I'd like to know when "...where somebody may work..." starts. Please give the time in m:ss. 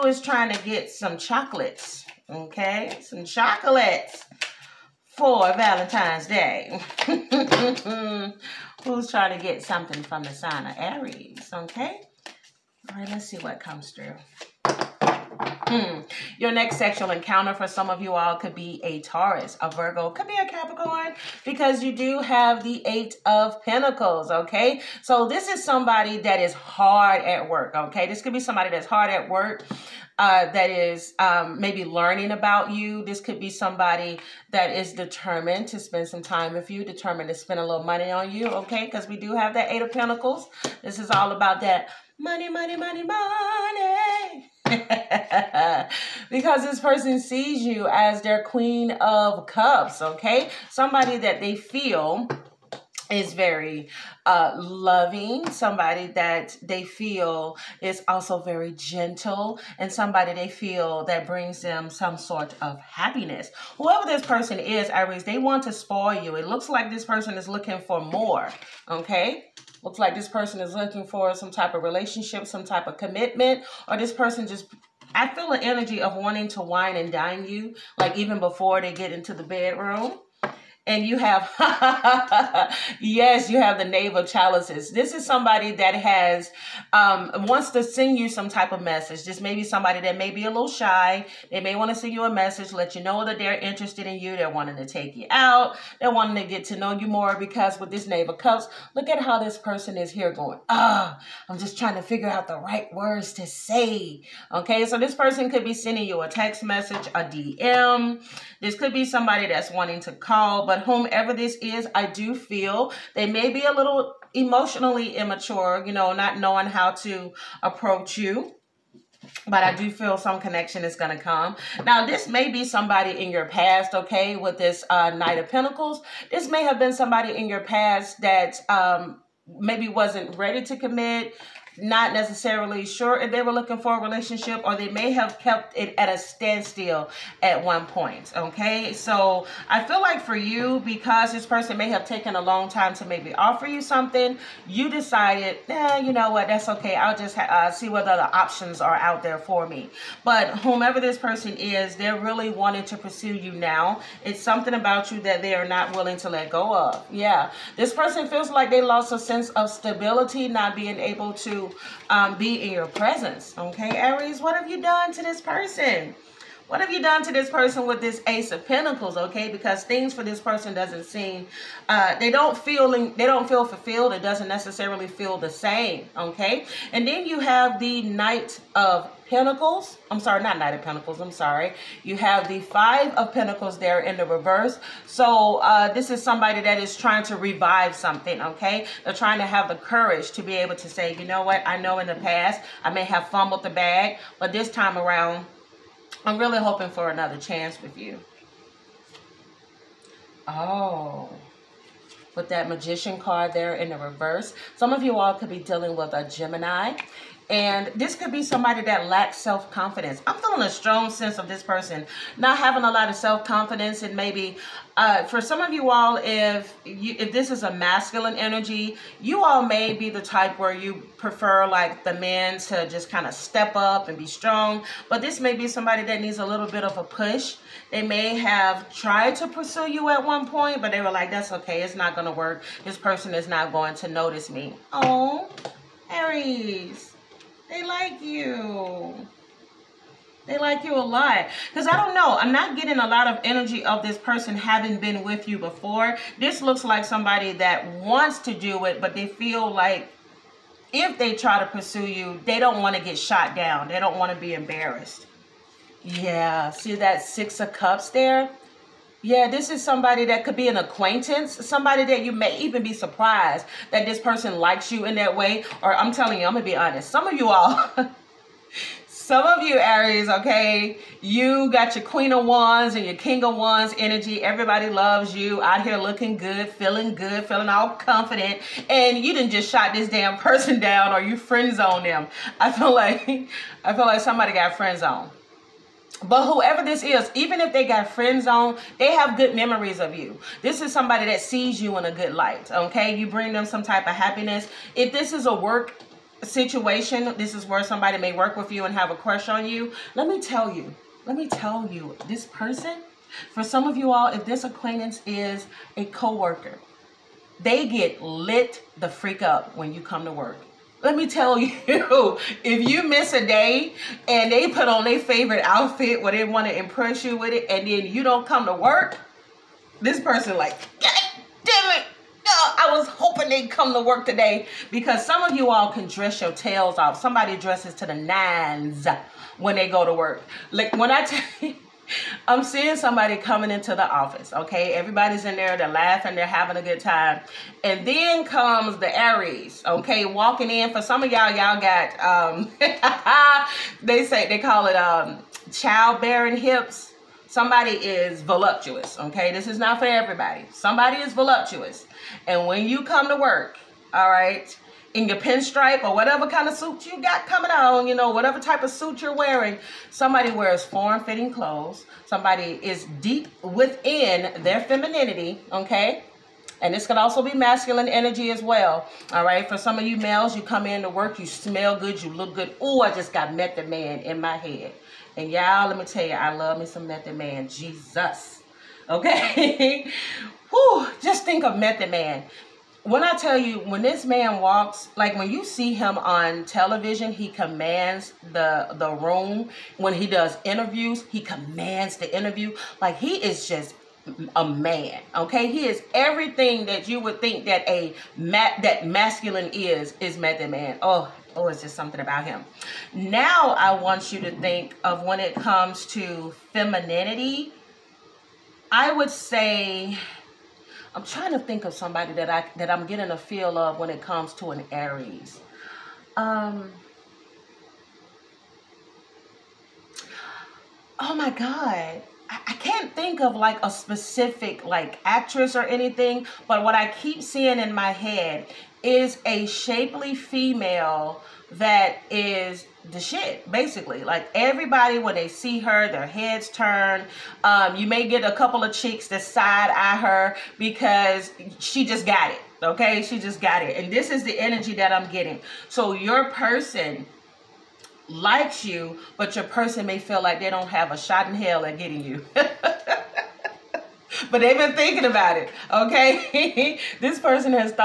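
4:57.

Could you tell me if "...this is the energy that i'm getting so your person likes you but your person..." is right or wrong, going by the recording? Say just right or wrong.
right.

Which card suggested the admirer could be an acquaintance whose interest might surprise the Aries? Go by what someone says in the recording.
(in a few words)
Six of Cups.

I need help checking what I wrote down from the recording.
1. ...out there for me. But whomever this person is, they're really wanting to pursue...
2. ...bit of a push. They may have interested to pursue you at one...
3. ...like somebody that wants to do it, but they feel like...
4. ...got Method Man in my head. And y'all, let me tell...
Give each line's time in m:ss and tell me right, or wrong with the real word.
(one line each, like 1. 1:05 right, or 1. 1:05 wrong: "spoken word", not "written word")
1. 2:28 right
2. 3:46 wrong: "tried", not "interested"
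3. 4:06 right
4. 6:13 right.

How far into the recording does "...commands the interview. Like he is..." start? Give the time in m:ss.
6:31.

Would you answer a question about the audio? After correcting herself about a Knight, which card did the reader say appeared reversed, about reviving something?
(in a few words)
Five of Pentacles.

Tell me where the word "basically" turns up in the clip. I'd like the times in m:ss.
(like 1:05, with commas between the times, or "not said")
7:13.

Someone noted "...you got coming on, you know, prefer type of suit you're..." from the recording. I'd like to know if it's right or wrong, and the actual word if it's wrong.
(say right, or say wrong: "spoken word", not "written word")
wrong: "whatever", not "prefer".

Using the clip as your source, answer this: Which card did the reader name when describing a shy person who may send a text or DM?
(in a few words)
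Knave of Chalices.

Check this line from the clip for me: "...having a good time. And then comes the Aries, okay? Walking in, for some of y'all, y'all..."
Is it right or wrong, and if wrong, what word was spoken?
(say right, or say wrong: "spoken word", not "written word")
right.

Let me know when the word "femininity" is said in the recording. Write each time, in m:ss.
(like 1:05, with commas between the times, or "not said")
6:04, 6:46.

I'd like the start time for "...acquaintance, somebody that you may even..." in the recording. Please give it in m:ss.
4:20.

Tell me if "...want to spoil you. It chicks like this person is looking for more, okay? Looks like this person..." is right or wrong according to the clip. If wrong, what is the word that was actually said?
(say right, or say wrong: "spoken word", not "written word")
wrong: "looks", not "chicks".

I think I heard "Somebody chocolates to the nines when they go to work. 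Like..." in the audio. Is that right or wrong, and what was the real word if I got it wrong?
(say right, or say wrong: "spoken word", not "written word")
wrong: "dresses", not "chocolates".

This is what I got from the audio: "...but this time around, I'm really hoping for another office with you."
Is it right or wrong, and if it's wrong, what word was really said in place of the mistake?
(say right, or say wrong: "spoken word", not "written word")
wrong: "chance", not "office".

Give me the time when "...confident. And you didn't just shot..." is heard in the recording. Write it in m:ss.
4:37.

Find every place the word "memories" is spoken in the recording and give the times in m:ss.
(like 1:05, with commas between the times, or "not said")
4:49.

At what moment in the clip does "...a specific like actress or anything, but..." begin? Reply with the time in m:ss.
7:03.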